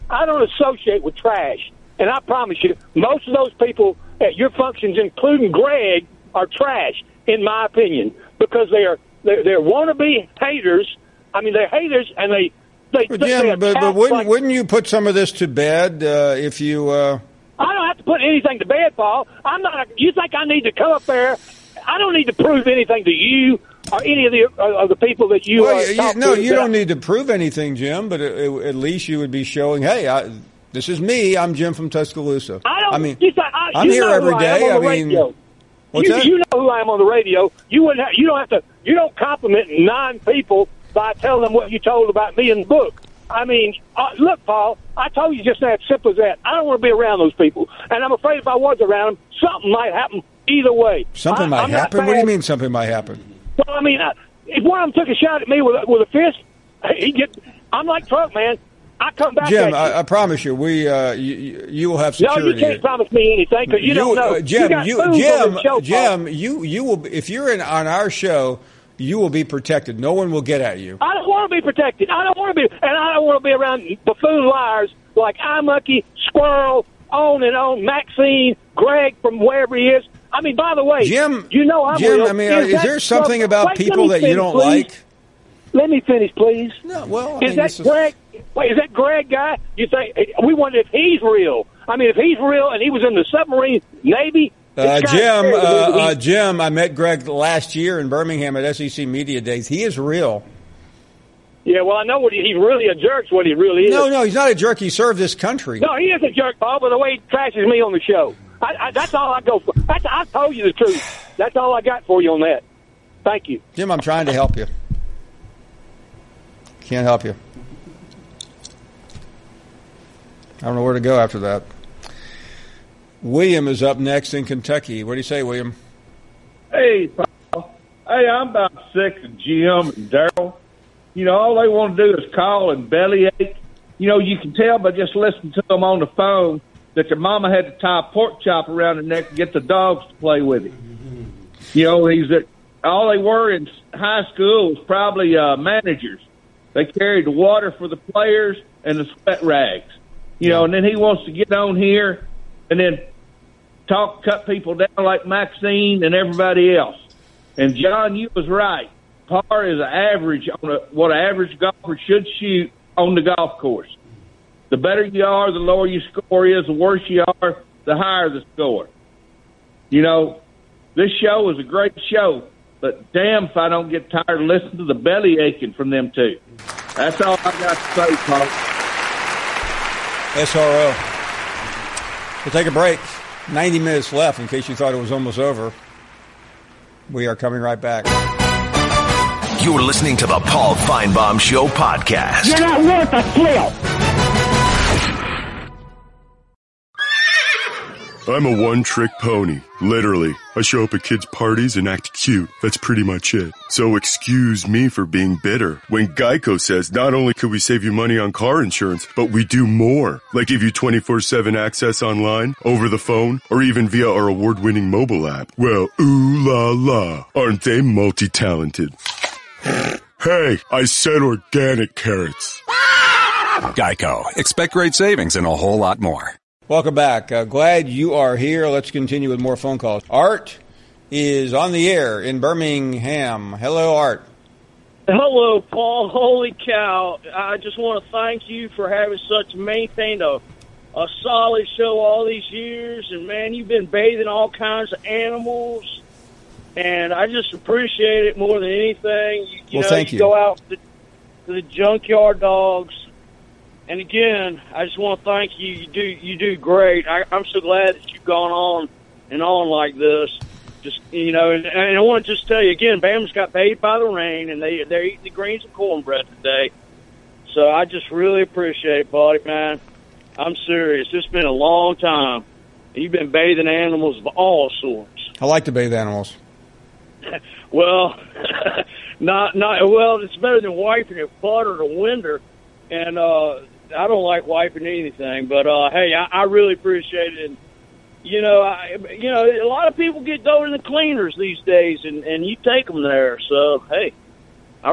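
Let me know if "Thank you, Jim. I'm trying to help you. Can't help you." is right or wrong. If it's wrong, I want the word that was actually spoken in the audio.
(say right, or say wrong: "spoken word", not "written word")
right.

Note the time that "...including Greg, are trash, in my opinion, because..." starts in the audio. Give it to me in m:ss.
0:04.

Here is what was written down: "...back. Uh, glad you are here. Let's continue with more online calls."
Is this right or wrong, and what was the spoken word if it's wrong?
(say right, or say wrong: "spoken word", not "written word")
wrong: "phone", not "online".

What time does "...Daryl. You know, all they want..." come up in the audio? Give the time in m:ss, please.
2:10.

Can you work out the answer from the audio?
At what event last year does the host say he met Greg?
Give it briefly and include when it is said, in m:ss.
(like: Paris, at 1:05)
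SEC Media Days, at 1:38.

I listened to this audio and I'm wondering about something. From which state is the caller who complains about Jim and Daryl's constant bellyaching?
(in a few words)
Kentucky.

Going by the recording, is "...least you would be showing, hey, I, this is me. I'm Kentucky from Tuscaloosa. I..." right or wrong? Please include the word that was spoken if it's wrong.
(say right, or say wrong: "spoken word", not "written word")
wrong: "Jim", not "Kentucky".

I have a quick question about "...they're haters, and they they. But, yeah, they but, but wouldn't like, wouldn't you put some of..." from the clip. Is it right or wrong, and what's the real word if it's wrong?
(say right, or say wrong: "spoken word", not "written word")
right.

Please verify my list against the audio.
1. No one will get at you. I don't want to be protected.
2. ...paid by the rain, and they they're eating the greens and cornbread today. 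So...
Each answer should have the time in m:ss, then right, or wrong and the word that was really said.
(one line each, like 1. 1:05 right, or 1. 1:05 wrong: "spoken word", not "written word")
1. 1:09 right
2. 4:23 right.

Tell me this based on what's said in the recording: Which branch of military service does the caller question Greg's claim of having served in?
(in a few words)
submarine Navy.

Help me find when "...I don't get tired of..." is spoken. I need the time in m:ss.
2:53.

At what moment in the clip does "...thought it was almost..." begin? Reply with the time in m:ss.
3:04.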